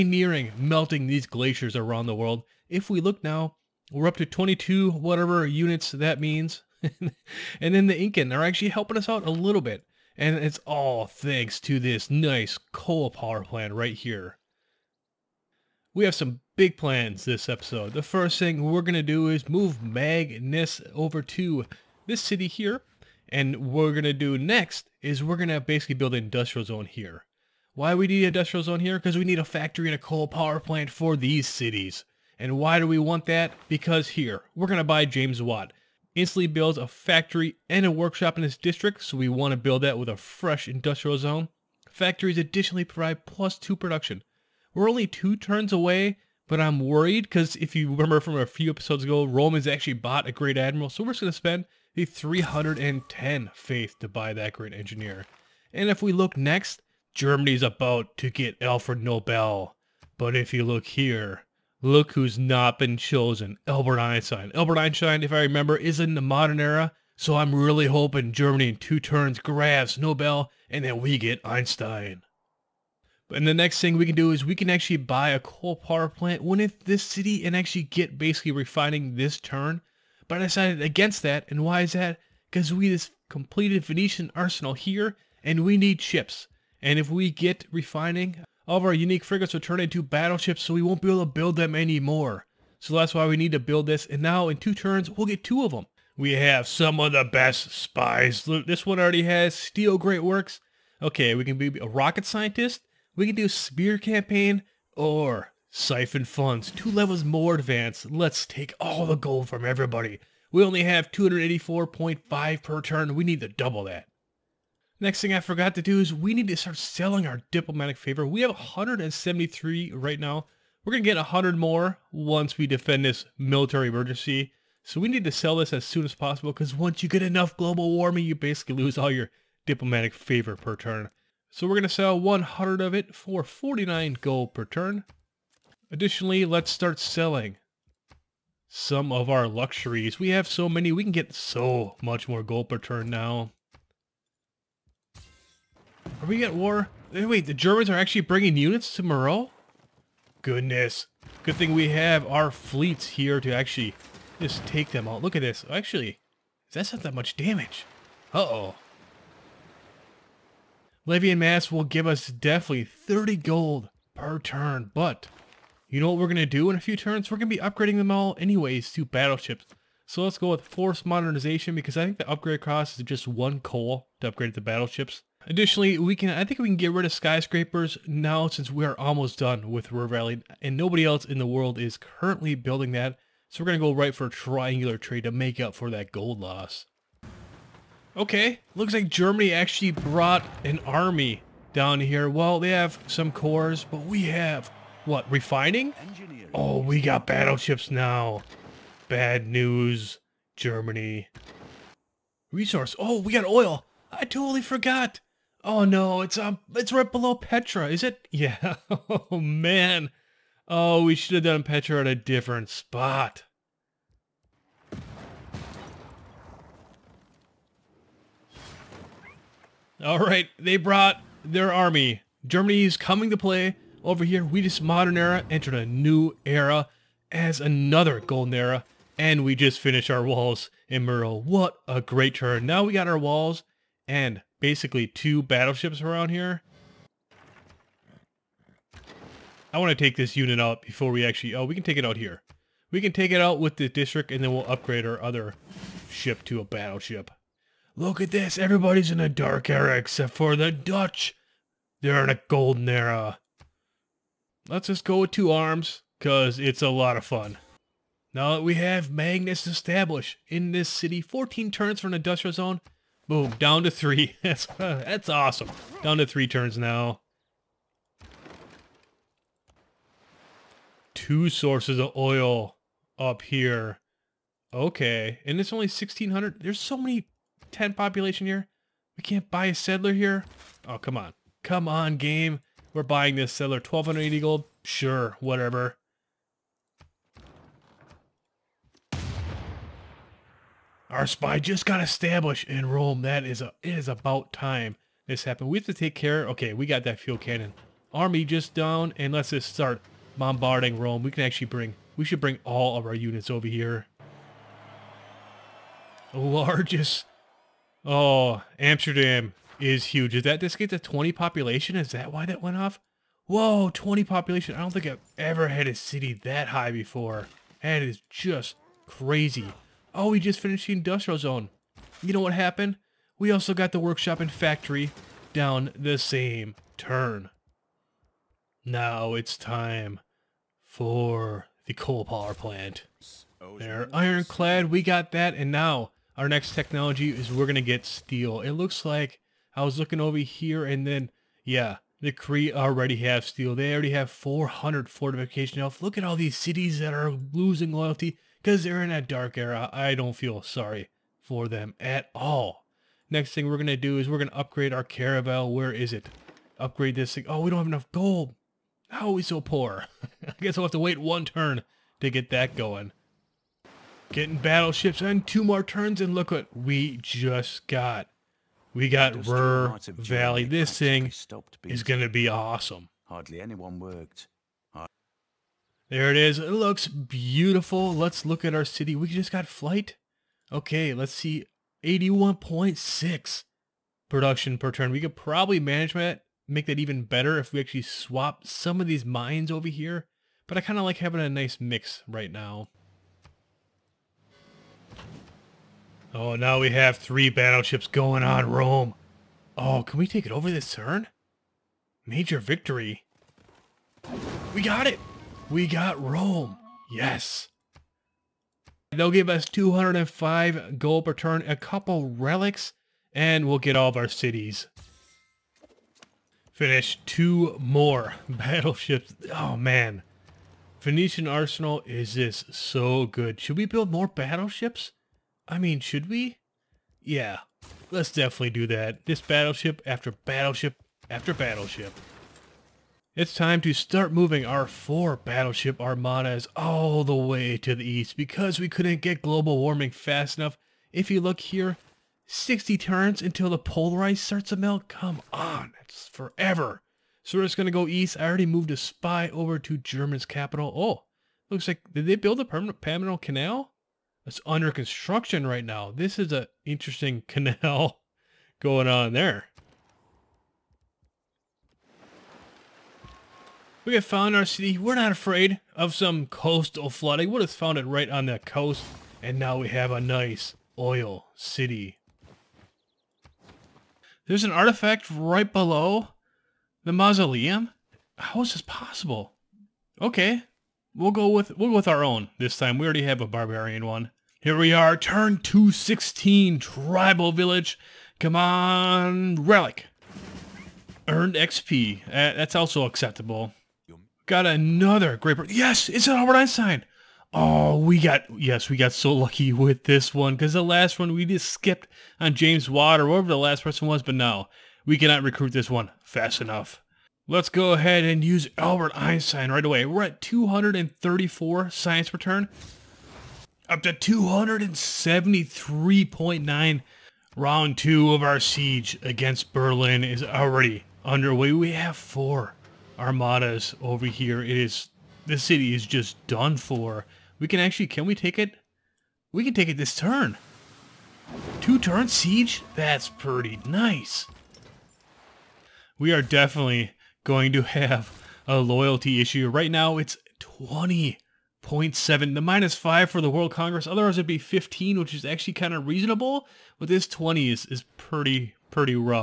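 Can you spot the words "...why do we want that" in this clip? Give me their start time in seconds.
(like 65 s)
32 s.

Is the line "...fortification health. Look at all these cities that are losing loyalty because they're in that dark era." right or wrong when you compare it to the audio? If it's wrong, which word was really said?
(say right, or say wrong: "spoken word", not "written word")
right.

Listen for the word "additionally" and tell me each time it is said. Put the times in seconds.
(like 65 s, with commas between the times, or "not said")
42 s, 135 s, 175 s.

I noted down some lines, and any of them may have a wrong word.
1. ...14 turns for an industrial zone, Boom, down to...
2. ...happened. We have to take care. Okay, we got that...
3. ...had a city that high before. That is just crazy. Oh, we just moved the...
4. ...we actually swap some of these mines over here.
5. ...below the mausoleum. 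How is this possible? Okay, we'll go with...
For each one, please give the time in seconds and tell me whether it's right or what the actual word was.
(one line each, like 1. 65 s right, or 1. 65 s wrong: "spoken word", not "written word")
1. 261 s right
2. 295 s right
3. 315 s wrong: "finished", not "moved"
4. 387 s right
5. 475 s right.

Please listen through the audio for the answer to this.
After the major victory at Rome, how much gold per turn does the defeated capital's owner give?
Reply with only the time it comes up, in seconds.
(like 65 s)
409 s.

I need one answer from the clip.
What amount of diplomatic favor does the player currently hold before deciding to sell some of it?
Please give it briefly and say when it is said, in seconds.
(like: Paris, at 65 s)
173, at 118 s.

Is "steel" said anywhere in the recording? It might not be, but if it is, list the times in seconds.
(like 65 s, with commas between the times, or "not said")
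338 s, 343 s.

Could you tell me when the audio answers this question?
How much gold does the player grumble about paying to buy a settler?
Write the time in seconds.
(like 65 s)
283 s.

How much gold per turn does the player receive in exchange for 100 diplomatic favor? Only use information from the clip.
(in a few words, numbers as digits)
49.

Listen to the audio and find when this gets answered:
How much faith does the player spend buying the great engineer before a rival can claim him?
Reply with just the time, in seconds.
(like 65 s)
52 s.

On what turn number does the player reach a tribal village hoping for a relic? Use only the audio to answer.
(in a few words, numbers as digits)
216.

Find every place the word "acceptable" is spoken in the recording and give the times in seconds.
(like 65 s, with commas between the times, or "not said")
493 s.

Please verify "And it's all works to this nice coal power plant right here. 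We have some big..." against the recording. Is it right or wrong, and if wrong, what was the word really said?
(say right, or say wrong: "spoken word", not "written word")
wrong: "thanks", not "works".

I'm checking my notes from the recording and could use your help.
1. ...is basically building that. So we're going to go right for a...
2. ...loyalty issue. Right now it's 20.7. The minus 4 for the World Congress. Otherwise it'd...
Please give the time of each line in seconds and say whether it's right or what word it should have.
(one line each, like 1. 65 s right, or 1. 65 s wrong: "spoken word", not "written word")
1. 181 s wrong: "currently", not "basically"
2. 538 s wrong: "5", not "4".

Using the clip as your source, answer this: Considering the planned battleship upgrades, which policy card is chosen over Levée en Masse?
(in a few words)
Force modernization.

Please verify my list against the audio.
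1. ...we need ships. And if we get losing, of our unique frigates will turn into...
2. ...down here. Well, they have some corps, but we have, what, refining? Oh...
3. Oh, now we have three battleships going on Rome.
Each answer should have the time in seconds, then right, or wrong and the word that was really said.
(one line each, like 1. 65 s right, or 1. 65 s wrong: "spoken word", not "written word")
1. 85 s wrong: "refining", not "losing"
2. 191 s right
3. 396 s right.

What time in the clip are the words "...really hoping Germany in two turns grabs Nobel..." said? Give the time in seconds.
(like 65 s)
67 s.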